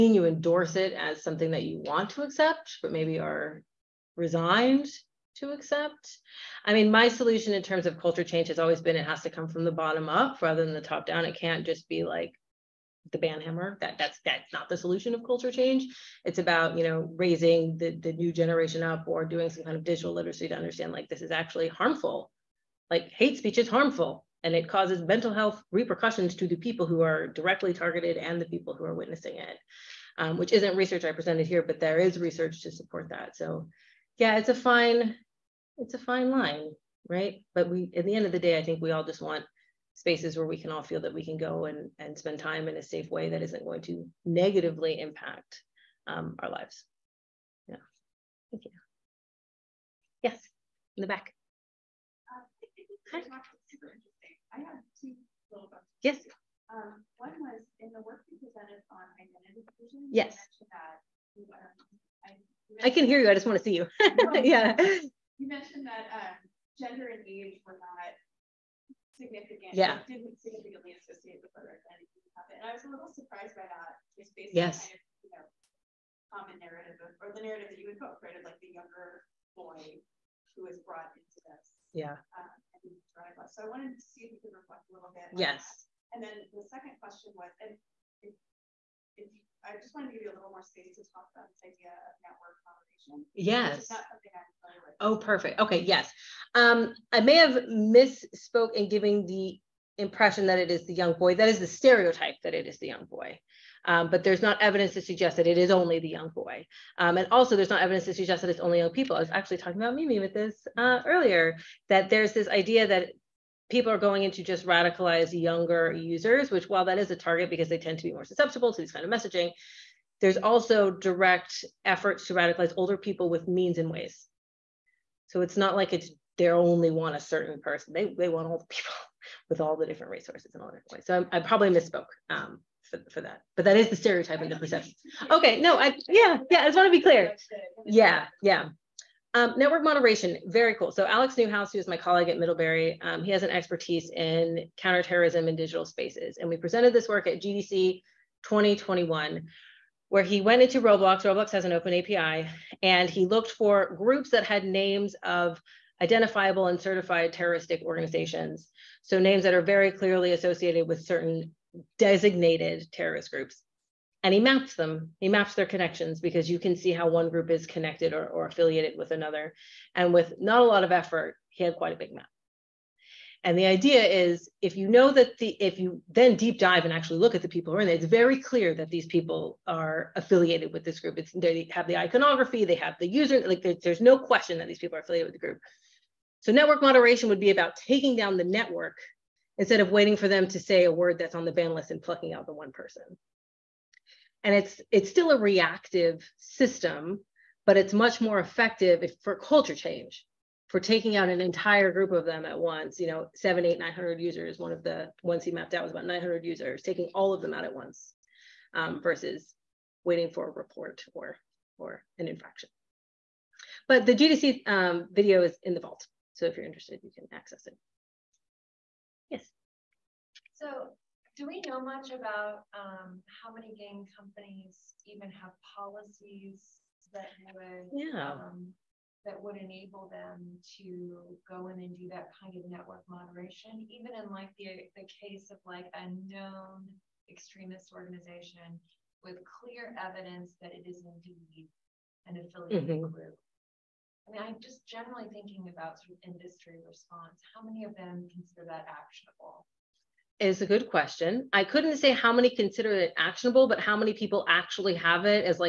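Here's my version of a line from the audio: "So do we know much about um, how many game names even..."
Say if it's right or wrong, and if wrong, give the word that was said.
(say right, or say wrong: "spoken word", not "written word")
wrong: "companies", not "names".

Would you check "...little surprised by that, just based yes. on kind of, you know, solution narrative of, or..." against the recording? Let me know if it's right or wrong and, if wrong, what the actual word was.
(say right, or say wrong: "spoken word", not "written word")
wrong: "common", not "solution".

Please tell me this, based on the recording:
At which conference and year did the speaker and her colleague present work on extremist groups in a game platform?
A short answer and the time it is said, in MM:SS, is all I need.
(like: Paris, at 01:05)
GDC 2021, at 02:27.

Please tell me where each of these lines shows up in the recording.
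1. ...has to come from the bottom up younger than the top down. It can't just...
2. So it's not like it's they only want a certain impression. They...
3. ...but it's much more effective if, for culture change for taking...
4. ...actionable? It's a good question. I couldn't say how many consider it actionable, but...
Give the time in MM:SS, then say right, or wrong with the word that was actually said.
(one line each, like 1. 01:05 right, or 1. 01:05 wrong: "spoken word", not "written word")
1. 00:09 wrong: "rather", not "younger"
2. 02:05 wrong: "person", not "impression"
3. 03:17 right
4. 04:08 right.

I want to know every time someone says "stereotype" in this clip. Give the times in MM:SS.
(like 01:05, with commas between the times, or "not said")
01:41, 02:13.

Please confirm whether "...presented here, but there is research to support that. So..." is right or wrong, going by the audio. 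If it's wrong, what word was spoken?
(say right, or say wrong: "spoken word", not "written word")
right.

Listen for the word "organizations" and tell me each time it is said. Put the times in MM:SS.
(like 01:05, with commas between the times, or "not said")
02:37, 03:57.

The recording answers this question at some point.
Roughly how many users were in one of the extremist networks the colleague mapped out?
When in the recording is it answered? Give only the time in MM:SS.
03:25.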